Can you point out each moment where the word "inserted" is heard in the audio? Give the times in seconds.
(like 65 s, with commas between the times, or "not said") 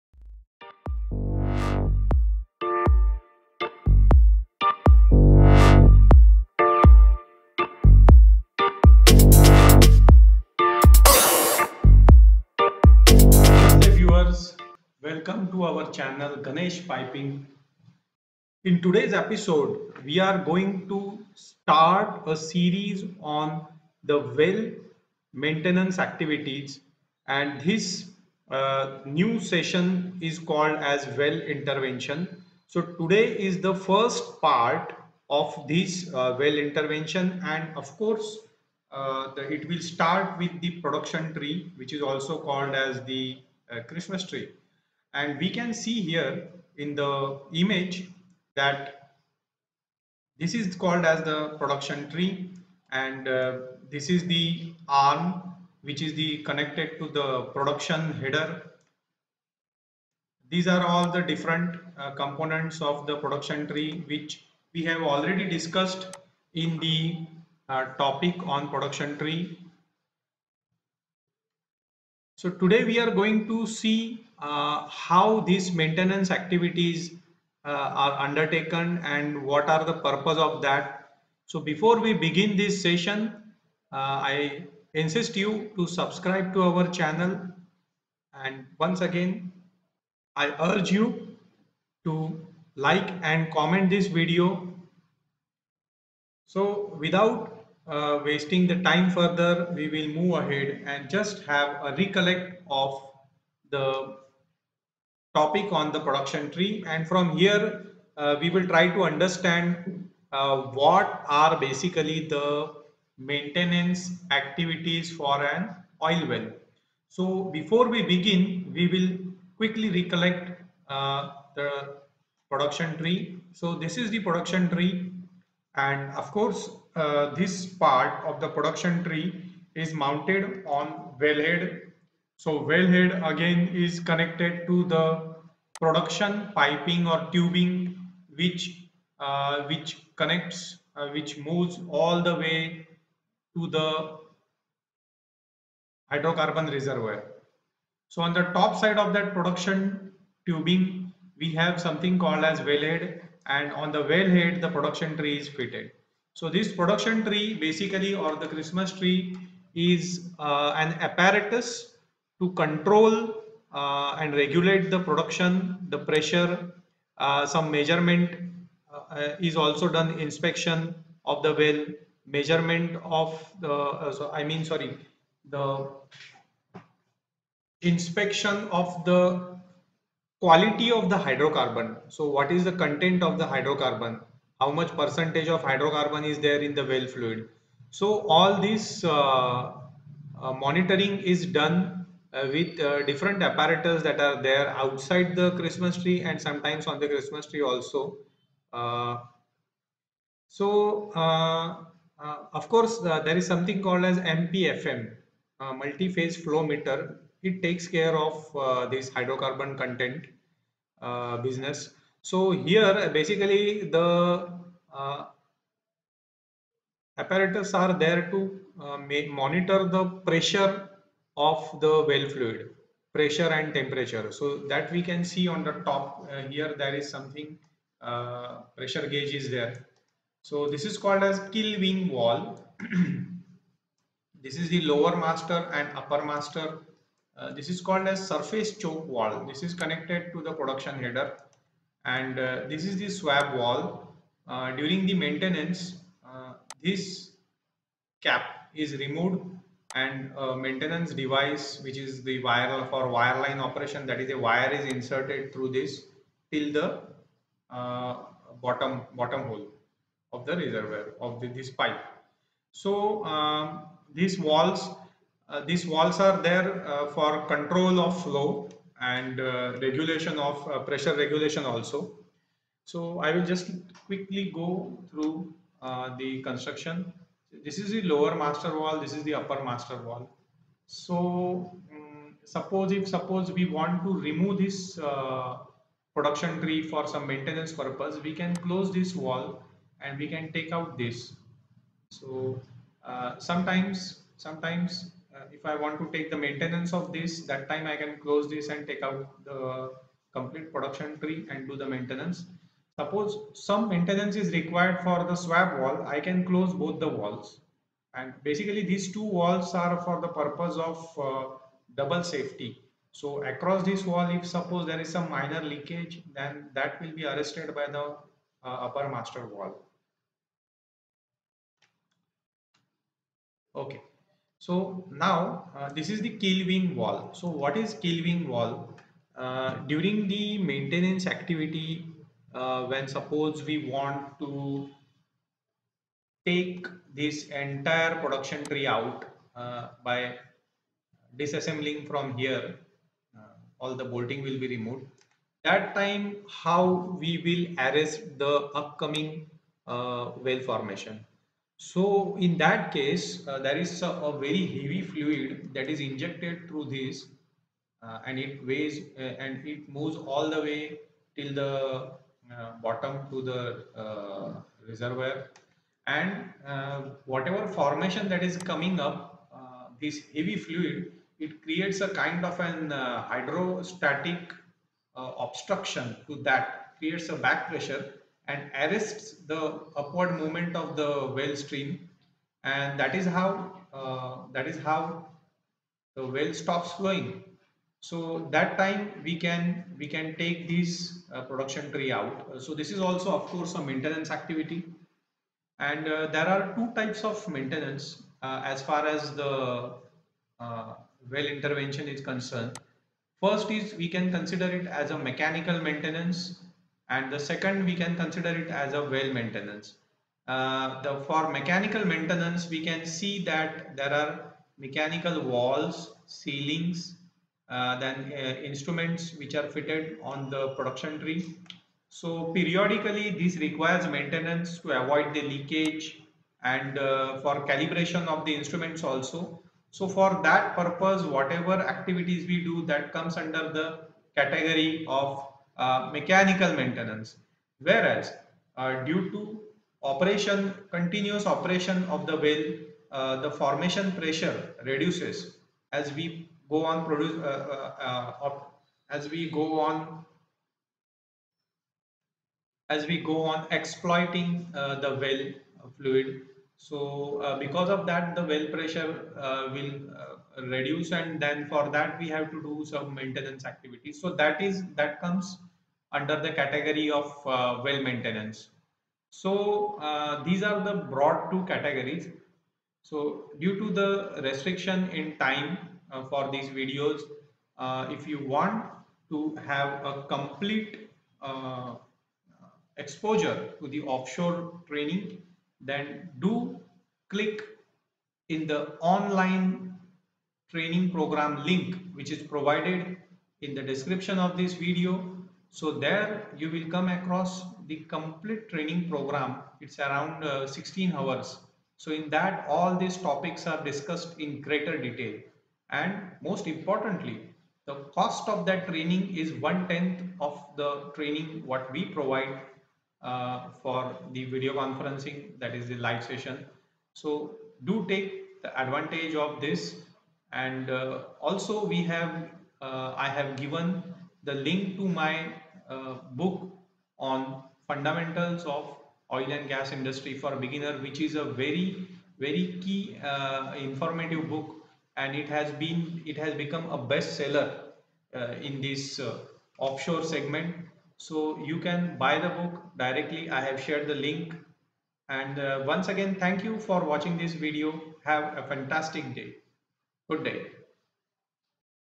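254 s.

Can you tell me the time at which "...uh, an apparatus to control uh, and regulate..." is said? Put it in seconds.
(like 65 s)
160 s.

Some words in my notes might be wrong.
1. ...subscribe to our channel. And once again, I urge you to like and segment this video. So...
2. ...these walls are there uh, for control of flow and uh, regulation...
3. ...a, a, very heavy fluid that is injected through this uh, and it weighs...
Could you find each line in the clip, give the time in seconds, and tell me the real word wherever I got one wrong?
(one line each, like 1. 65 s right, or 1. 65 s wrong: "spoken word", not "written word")
1. 85 s wrong: "comment", not "segment"
2. 265 s right
3. 354 s right.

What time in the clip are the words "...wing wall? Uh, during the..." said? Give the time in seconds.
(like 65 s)
328 s.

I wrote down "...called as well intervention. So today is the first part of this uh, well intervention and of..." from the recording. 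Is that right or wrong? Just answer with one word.
right.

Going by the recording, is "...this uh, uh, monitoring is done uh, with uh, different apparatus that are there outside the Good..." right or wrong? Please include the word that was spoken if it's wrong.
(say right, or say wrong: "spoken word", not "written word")
wrong: "Christmas", not "Good".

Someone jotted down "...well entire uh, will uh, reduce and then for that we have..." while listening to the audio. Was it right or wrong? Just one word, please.
wrong.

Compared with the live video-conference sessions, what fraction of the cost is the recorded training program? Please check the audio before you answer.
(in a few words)
One tenth.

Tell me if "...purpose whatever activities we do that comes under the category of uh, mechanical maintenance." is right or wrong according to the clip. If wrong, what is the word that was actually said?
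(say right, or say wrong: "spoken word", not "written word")
right.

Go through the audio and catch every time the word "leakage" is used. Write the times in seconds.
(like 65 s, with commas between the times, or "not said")
315 s, 425 s.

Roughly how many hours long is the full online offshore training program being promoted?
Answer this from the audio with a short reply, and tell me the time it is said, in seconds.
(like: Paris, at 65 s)
16, at 500 s.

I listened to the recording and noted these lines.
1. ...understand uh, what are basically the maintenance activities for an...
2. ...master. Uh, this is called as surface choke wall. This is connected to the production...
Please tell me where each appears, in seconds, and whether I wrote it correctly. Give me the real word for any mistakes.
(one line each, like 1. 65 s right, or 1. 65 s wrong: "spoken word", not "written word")
1. 109 s right
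2. 236 s right.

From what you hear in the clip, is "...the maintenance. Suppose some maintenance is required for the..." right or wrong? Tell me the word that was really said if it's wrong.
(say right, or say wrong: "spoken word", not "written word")
right.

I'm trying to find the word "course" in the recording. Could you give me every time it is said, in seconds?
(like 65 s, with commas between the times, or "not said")
37 s, 126 s, 202 s, 393 s.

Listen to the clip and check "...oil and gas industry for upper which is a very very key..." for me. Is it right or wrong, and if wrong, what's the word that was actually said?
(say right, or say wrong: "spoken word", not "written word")
wrong: "beginner", not "upper".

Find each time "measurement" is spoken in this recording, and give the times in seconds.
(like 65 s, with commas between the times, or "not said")
167 s, 172 s.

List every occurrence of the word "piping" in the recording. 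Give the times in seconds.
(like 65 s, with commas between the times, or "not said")
16 s, 136 s.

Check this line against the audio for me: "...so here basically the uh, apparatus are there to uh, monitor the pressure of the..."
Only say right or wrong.
right.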